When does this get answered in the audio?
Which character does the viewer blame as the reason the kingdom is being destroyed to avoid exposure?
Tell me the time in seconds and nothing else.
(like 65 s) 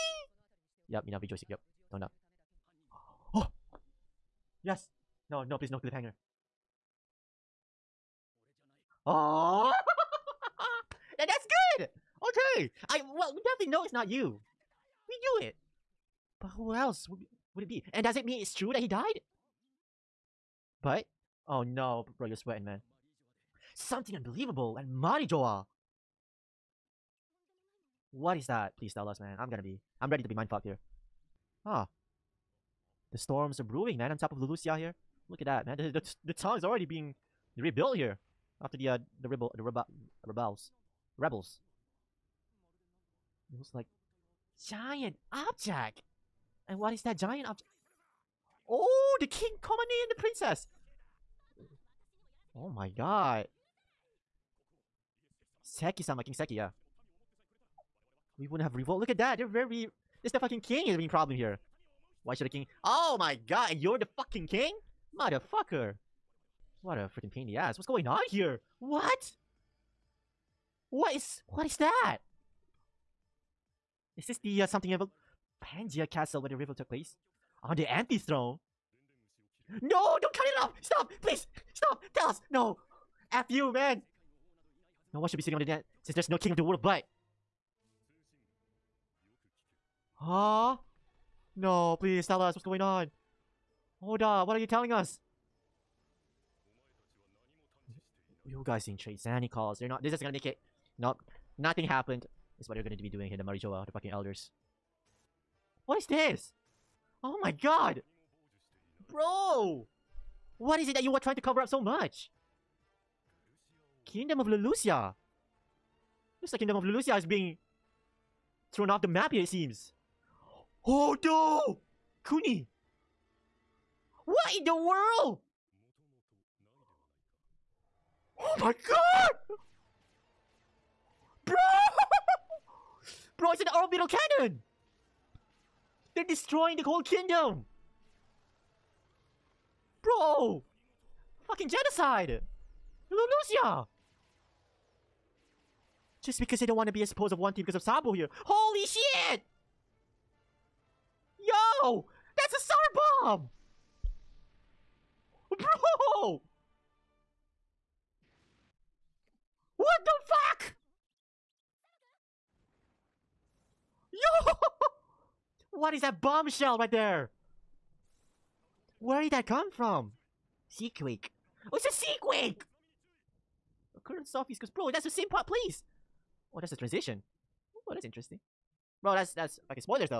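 147 s.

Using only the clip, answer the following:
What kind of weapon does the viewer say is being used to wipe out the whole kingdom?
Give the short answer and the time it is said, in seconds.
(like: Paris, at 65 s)
Orbital cannon, at 133 s.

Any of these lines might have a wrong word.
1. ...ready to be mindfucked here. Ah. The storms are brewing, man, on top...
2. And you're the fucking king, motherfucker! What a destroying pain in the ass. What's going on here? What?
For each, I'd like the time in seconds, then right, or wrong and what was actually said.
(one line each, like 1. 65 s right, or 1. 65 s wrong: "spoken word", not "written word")
1. 30 s right
2. 63 s wrong: "freaking", not "destroying".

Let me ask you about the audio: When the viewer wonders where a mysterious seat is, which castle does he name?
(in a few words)
Pangaea Castle.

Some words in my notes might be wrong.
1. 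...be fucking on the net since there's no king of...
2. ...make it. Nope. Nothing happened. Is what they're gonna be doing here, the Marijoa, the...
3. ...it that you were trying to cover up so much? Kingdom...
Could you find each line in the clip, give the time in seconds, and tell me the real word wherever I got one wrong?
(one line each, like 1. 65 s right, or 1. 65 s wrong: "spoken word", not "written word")
1. 85 s wrong: "sitting", not "fucking"
2. 100 s right
3. 110 s right.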